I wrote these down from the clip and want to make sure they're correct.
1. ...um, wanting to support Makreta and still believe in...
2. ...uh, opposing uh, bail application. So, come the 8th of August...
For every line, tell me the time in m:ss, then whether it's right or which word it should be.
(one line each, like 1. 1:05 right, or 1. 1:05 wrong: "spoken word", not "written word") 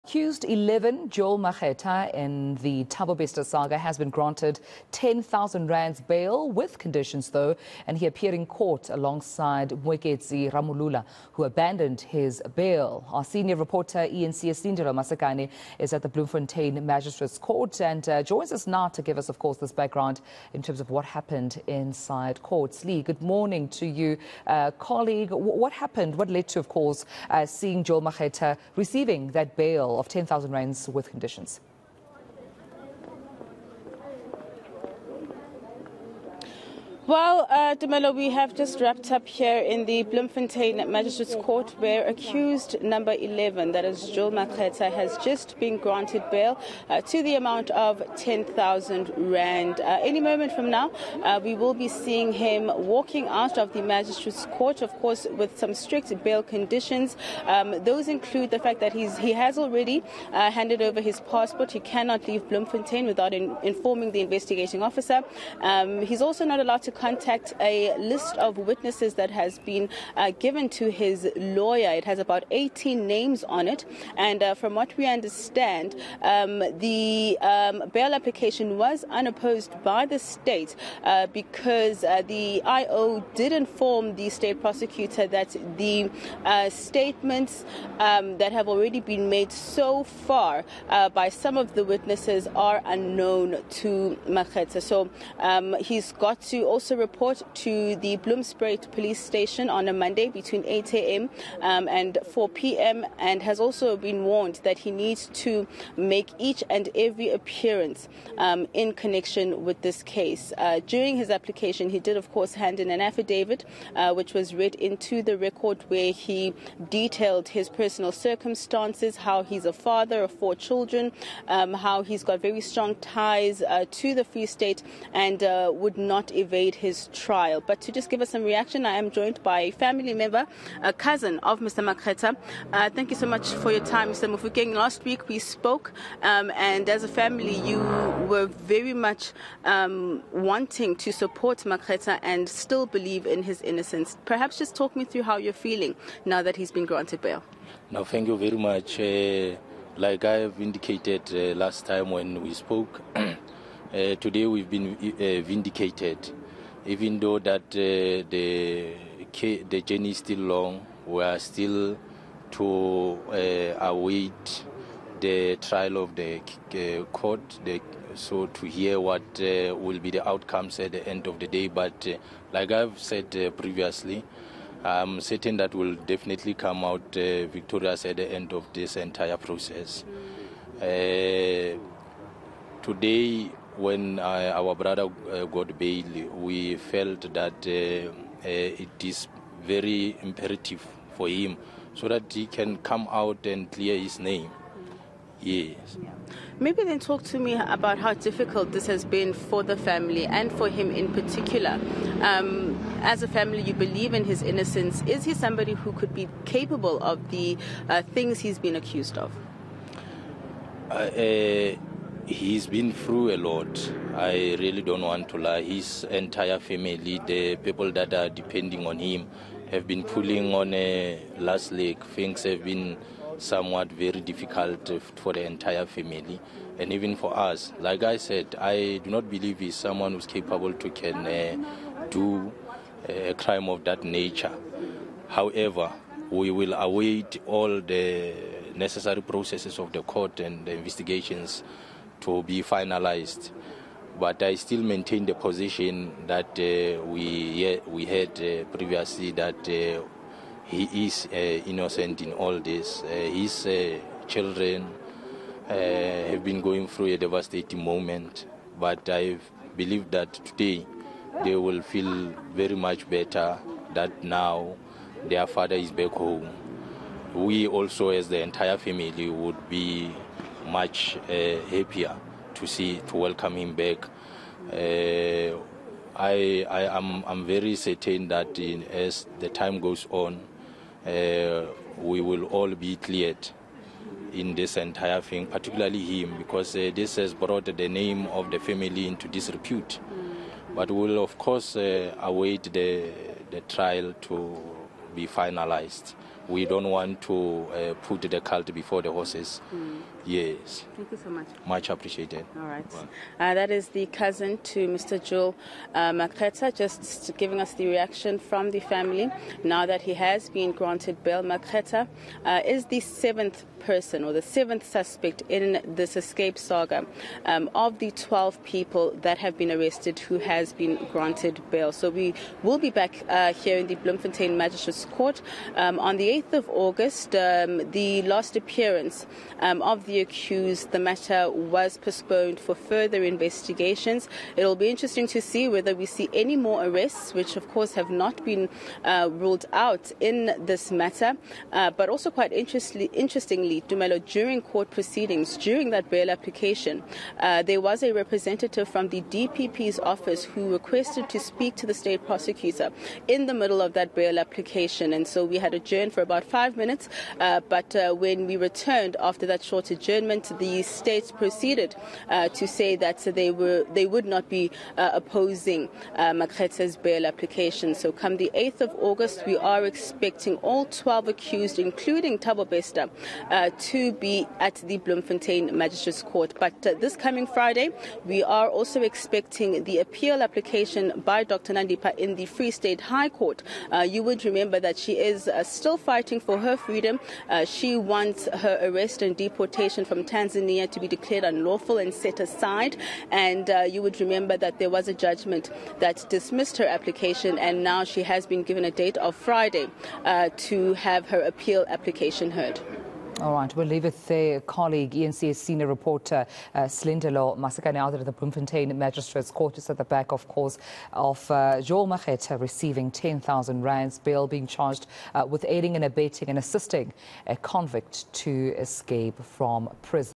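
1. 2:19 right
2. 6:04 right.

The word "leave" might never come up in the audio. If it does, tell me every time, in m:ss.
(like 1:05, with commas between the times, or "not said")
1:02, 6:43.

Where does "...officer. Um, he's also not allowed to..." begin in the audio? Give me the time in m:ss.
1:04.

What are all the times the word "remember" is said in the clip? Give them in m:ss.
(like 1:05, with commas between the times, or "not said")
6:24, 6:34.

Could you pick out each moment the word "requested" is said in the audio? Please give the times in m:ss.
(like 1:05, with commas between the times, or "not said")
5:50.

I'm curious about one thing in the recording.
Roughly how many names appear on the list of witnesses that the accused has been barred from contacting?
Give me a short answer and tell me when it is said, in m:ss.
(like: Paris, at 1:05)
18, at 1:12.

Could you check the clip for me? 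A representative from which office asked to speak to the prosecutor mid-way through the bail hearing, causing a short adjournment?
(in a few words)
DPP's office.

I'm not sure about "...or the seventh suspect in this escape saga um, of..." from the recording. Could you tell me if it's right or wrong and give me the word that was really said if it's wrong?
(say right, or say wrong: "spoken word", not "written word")
right.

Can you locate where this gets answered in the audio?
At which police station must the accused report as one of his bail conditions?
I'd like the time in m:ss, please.
1:38.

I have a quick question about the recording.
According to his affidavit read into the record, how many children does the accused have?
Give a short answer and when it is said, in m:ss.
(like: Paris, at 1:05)
4, at 1:59.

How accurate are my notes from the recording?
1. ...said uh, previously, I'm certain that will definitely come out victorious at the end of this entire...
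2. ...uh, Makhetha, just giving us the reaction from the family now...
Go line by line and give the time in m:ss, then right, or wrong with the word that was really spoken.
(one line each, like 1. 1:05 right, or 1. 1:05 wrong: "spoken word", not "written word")
1. 2:52 right
2. 5:05 right.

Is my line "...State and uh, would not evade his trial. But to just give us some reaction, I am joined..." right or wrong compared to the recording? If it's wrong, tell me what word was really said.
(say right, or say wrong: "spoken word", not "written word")
right.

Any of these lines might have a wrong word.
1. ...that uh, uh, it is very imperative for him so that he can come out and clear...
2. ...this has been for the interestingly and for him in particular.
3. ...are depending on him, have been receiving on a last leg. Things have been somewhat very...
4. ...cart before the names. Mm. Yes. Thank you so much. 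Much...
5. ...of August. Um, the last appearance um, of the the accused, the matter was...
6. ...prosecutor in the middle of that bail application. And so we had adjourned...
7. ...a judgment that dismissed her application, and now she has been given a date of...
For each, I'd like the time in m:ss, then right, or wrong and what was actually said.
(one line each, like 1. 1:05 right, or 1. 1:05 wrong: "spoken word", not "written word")
1. 3:07 right
2. 3:18 wrong: "family", not "interestingly"
3. 3:38 wrong: "pulling", not "receiving"
4. 4:58 wrong: "horses", not "names"
5. 5:26 right
6. 5:52 right
7. 6:35 right.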